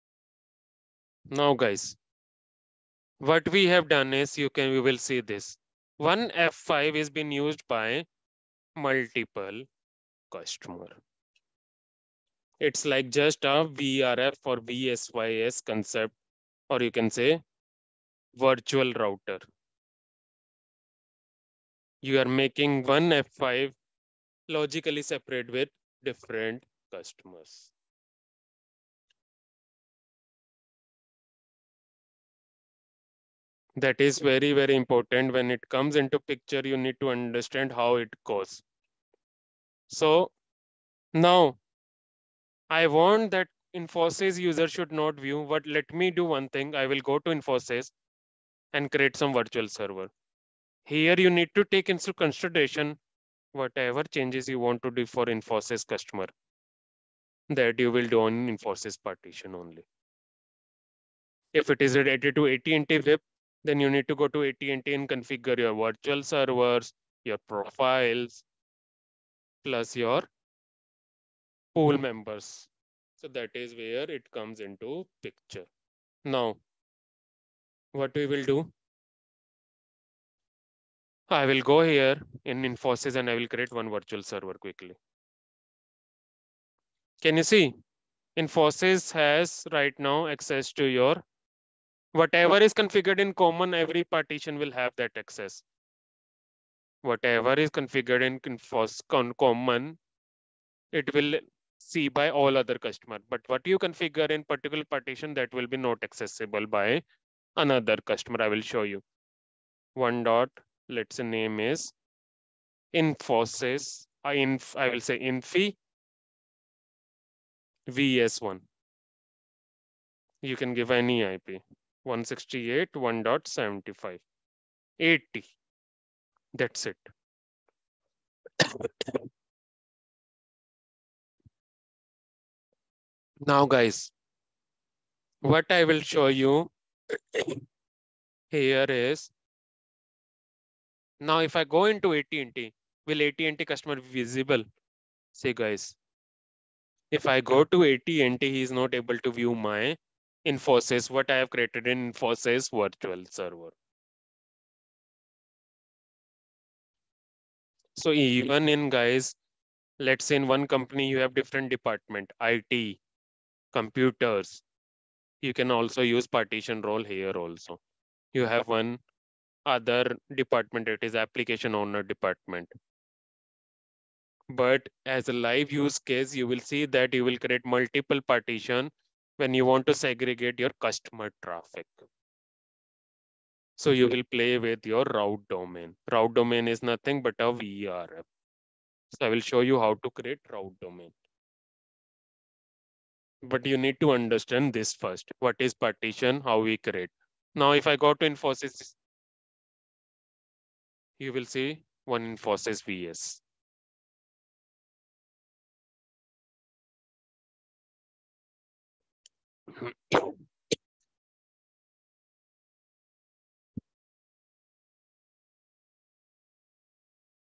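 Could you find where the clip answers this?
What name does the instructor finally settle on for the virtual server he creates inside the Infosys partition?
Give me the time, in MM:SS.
01:55.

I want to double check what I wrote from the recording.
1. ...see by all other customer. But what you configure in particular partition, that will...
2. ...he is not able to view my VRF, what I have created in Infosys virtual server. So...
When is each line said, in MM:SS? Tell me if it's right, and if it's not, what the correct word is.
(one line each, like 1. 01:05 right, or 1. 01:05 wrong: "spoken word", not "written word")
1. 01:41 right
2. 02:28 wrong: "Infosys", not "VRF".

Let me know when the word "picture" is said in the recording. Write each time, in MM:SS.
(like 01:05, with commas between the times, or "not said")
00:36, 01:15.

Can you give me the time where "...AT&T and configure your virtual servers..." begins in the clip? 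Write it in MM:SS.
01:04.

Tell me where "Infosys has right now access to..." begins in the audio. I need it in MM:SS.
01:28.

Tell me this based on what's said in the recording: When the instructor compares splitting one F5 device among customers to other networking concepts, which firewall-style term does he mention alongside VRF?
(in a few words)
VSYS.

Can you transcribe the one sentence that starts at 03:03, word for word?
So you will play with your route domain.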